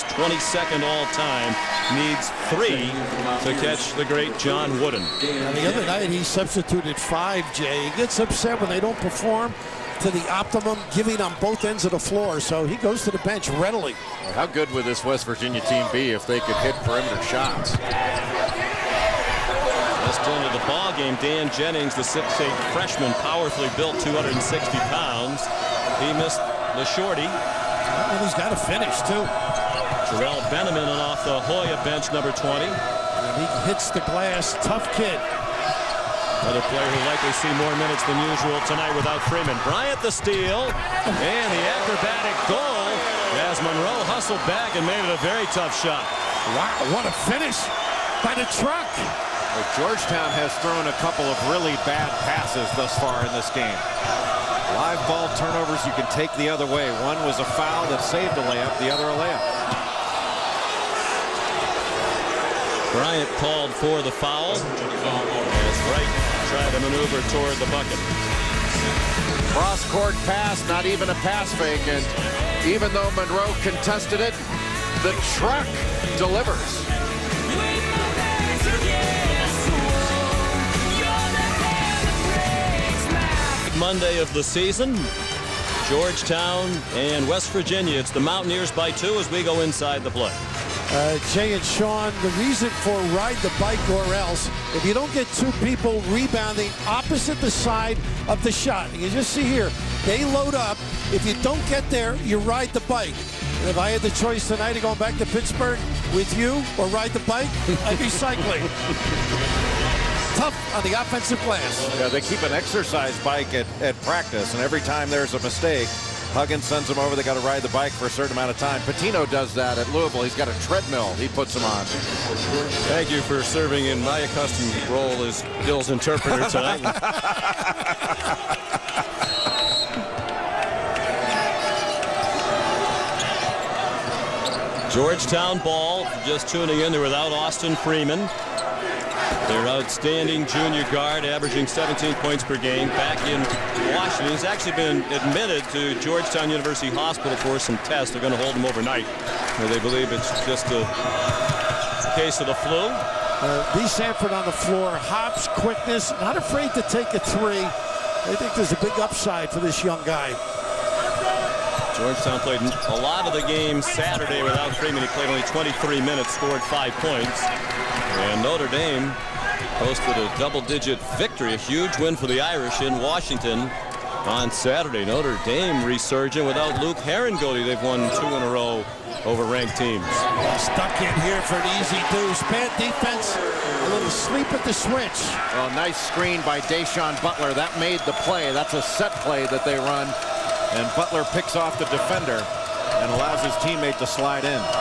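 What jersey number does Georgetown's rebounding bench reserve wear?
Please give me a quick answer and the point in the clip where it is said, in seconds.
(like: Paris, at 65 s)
20, at 32 s.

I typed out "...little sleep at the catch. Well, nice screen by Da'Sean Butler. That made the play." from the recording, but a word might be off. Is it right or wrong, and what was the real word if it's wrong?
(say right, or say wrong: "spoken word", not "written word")
wrong: "switch", not "catch".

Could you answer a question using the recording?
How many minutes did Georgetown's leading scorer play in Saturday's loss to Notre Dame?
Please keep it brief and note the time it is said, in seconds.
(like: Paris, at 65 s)
23, at 165 s.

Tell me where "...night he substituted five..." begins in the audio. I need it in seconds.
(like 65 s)
5 s.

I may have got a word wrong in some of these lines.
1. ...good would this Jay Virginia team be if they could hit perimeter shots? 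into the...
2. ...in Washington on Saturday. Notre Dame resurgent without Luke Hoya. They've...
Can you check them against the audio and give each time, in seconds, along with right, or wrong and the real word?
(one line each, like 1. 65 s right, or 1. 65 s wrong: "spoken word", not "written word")
1. 14 s wrong: "West", not "Jay"
2. 172 s wrong: "Harangody", not "Hoya".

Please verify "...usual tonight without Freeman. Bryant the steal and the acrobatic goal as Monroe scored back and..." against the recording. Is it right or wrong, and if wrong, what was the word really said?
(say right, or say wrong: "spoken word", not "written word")
wrong: "hustled", not "scored".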